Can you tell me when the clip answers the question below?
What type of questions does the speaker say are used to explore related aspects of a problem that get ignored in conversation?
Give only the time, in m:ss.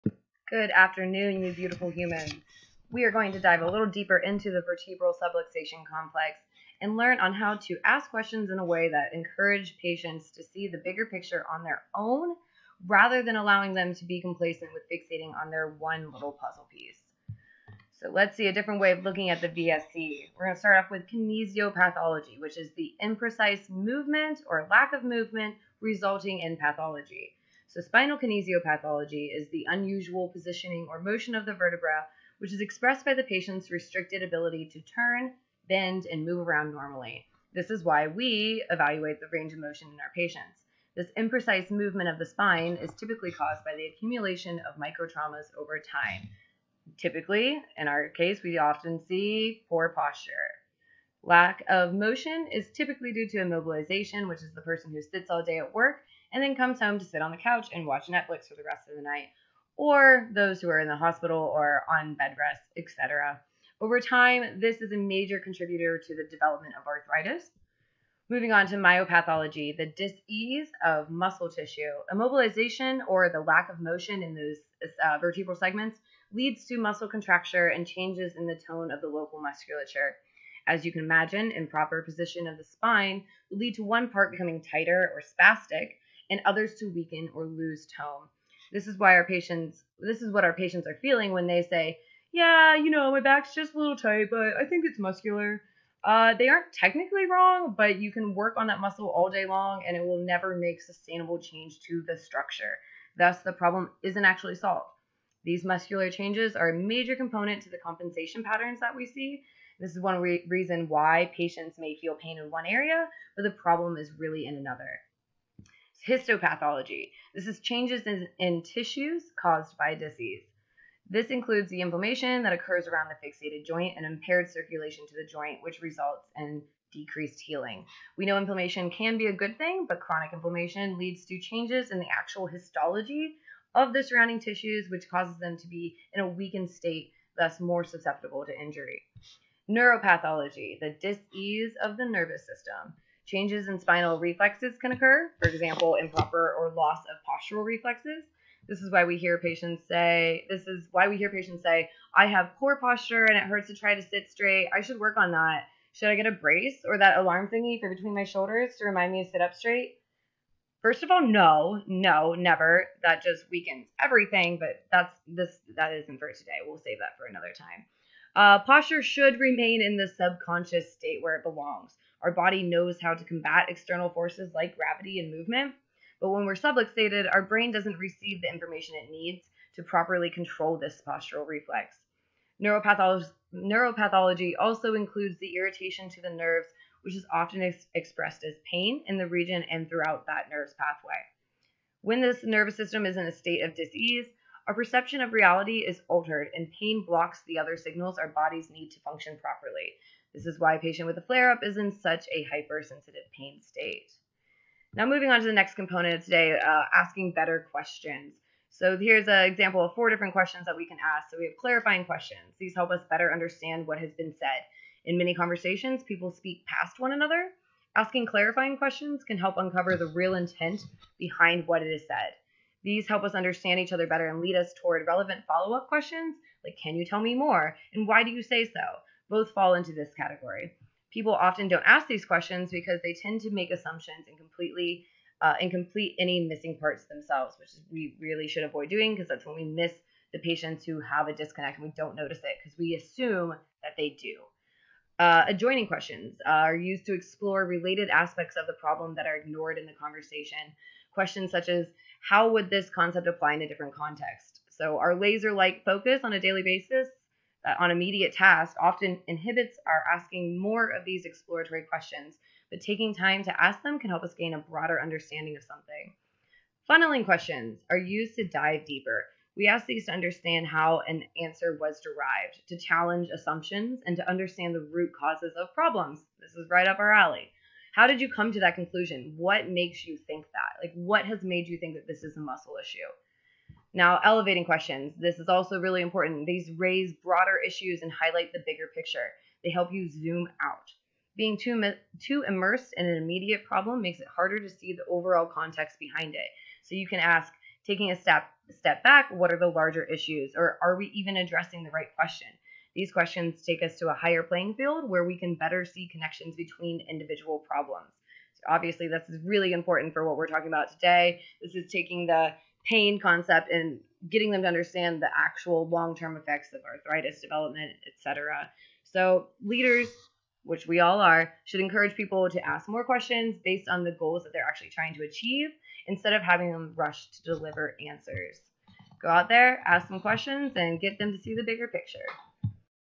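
4:05.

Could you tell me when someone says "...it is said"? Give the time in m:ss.
3:41.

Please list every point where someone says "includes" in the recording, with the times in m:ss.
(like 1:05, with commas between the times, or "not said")
2:01, 3:04.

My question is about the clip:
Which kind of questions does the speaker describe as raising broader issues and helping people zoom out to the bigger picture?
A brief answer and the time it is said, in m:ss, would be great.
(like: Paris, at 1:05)
elevating questions, at 4:44.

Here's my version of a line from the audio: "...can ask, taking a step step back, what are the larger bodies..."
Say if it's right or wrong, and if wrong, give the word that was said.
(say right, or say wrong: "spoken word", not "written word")
wrong: "issues", not "bodies".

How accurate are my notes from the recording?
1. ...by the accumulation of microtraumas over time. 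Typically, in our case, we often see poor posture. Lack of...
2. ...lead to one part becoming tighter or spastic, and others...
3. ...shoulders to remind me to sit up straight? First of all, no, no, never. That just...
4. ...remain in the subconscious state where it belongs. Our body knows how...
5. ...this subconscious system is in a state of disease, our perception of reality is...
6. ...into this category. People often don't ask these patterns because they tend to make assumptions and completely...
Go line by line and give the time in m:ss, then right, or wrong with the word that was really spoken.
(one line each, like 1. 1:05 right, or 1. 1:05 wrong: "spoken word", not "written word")
1. 0:43 right
2. 1:23 right
3. 2:38 right
4. 2:49 right
5. 3:12 wrong: "nervous", not "subconscious"
6. 3:49 wrong: "questions", not "patterns".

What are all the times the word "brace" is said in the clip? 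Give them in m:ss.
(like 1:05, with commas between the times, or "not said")
2:36.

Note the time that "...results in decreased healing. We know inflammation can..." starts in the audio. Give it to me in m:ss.
2:05.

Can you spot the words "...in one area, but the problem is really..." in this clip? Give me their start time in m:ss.
1:52.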